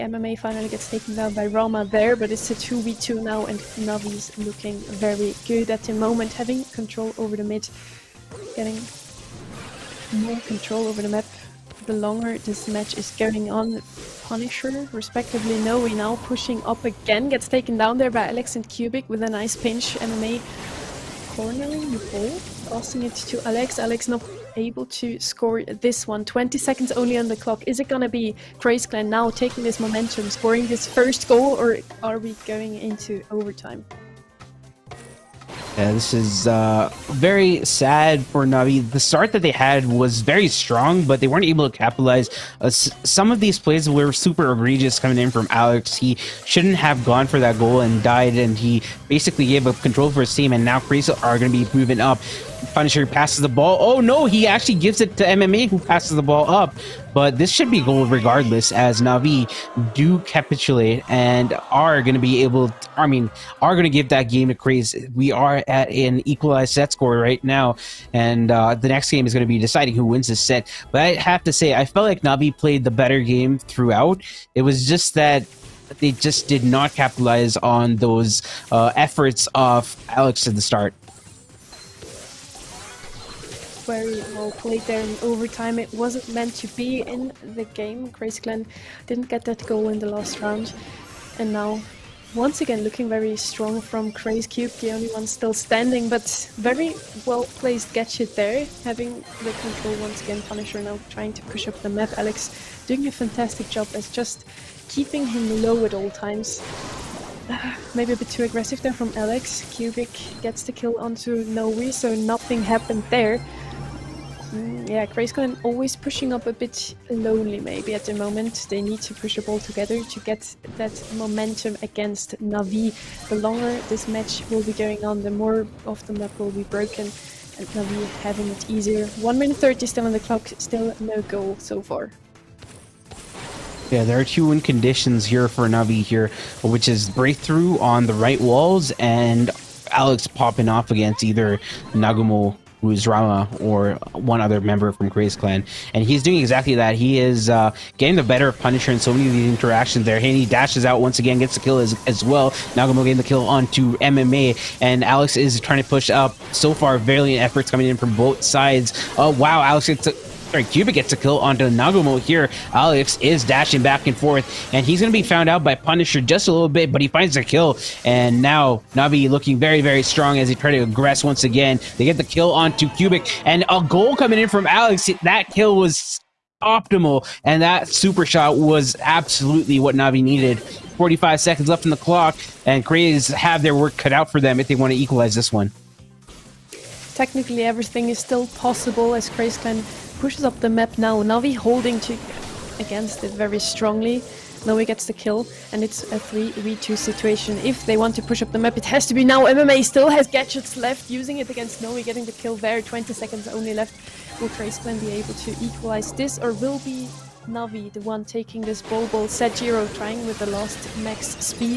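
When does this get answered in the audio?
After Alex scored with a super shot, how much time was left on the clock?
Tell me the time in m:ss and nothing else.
3:00.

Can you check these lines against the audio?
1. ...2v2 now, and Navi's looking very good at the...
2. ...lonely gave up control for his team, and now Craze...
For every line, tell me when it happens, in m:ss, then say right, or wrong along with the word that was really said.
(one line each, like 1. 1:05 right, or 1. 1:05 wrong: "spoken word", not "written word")
1. 0:02 right
2. 0:49 wrong: "basically", not "lonely".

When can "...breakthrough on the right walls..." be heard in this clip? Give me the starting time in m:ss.
2:17.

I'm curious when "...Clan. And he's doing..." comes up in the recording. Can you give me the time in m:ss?
2:25.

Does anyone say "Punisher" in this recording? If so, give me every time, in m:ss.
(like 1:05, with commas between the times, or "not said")
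0:14, 0:52, 1:40, 2:28, 2:45.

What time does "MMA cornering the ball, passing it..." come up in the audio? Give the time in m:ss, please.
0:19.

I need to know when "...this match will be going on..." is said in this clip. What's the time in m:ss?
2:03.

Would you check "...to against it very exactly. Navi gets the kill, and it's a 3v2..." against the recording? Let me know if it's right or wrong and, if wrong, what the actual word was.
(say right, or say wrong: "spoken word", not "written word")
wrong: "strongly", not "exactly".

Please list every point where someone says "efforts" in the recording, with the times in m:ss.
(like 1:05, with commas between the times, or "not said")
1:18, 2:37.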